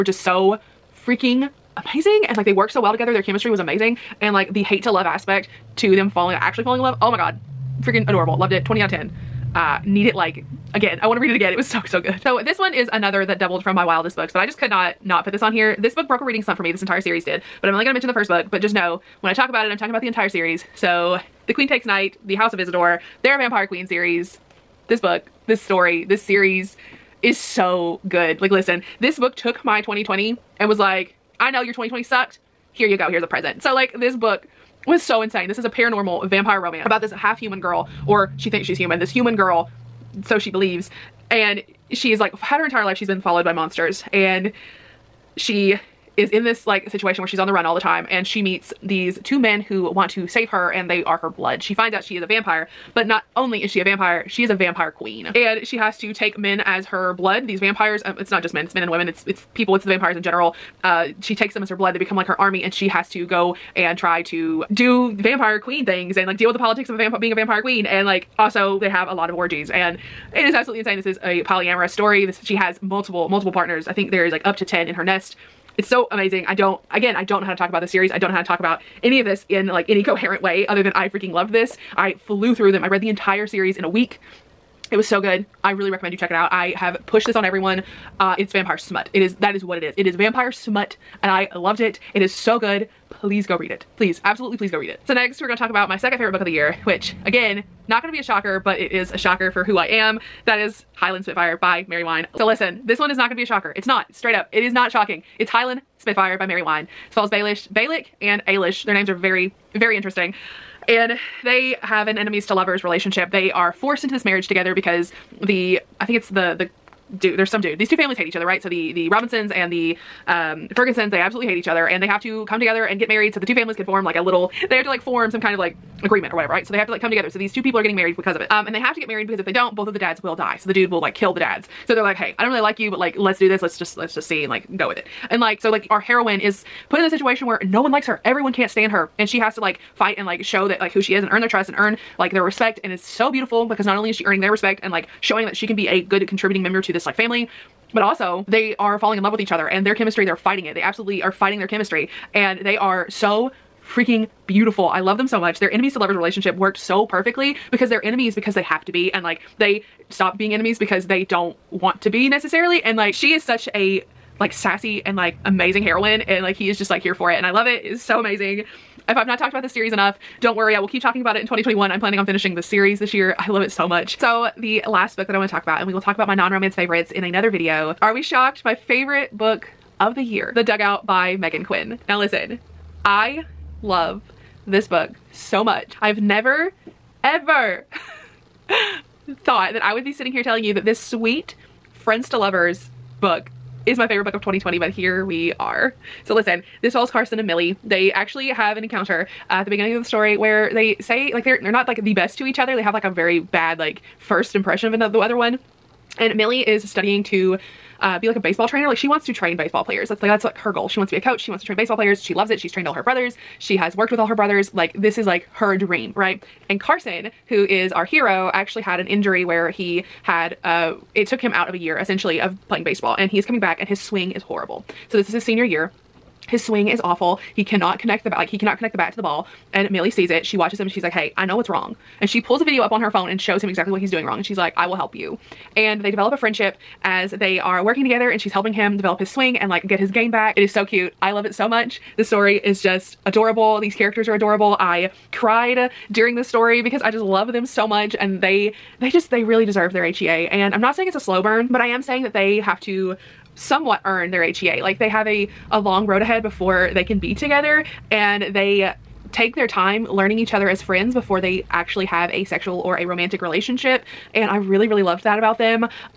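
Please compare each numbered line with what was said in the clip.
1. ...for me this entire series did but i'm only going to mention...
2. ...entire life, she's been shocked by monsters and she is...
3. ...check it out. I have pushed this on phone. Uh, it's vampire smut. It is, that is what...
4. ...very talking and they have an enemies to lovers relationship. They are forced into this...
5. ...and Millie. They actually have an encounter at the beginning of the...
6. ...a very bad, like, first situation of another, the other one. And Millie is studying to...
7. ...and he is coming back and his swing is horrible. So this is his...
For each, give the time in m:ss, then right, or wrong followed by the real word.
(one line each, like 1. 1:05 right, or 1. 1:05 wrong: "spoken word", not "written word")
1. 0:16 right
2. 0:42 wrong: "followed", not "shocked"
3. 1:26 wrong: "everyone", not "phone"
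4. 1:49 wrong: "interesting", not "talking"
5. 3:17 right
6. 3:23 wrong: "impression", not "situation"
7. 3:43 right.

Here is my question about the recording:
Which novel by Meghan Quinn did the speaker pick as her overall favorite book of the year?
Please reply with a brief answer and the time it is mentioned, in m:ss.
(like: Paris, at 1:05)
The Dugout, at 3:00.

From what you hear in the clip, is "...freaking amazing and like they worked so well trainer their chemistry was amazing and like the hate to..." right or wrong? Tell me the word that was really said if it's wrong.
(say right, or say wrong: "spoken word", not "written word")
wrong: "together", not "trainer".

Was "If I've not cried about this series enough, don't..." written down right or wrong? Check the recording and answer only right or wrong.
wrong.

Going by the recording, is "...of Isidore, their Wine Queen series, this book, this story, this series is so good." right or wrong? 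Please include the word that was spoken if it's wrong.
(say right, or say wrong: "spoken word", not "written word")
wrong: "Vampire", not "Wine".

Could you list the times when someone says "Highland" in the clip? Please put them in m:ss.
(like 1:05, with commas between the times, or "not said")
1:40, 1:45.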